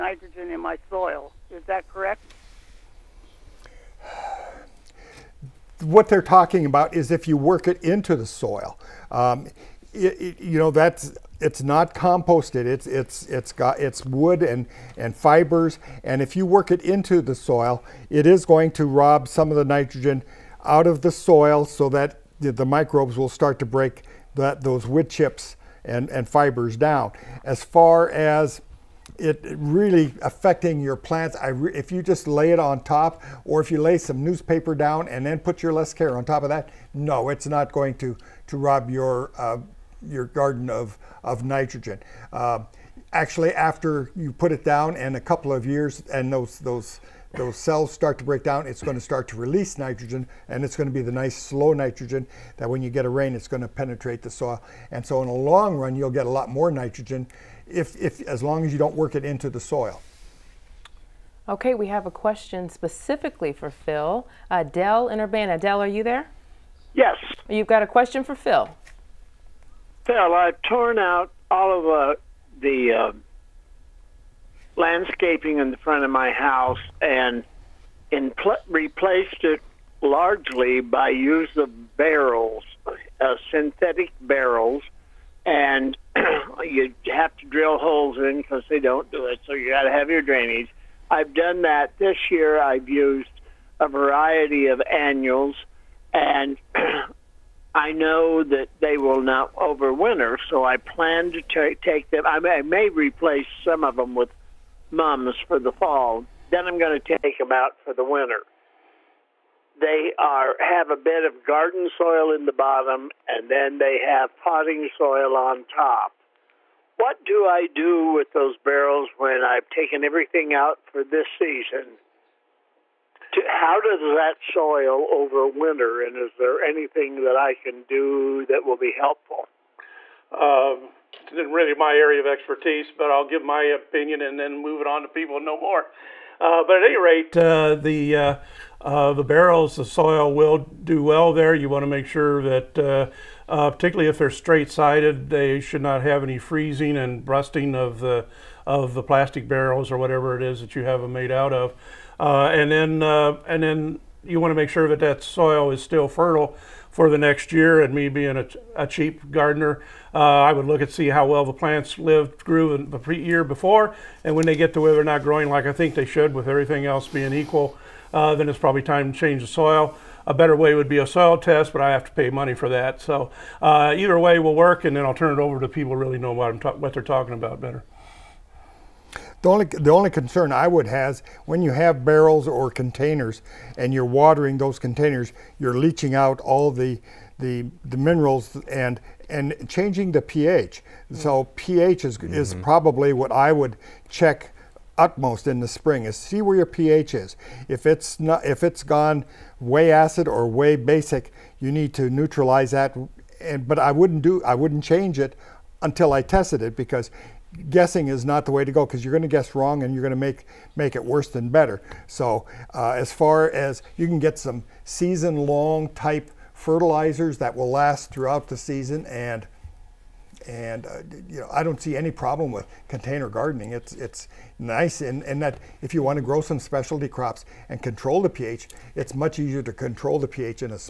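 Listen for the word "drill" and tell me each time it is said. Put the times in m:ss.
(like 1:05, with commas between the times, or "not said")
1:27.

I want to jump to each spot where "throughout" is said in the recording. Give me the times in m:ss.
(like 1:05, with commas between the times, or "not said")
3:38.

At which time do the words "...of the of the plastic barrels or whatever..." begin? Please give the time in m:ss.
2:27.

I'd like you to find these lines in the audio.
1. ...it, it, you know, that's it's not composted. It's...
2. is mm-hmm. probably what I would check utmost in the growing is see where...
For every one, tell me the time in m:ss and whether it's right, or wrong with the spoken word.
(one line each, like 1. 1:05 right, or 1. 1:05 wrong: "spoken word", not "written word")
1. 0:09 right
2. 3:12 wrong: "spring", not "growing".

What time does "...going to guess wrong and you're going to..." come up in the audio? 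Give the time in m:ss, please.
3:29.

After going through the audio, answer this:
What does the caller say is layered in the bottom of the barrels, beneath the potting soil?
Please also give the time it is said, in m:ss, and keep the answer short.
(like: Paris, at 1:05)
Garden soil, at 1:51.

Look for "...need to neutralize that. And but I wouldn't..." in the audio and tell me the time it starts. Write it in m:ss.
3:21.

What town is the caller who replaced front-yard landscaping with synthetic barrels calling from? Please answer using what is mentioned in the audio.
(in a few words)
Urbana.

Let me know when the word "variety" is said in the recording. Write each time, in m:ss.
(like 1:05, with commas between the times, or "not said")
1:33.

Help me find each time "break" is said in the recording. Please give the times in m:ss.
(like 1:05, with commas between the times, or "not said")
0:23, 0:48.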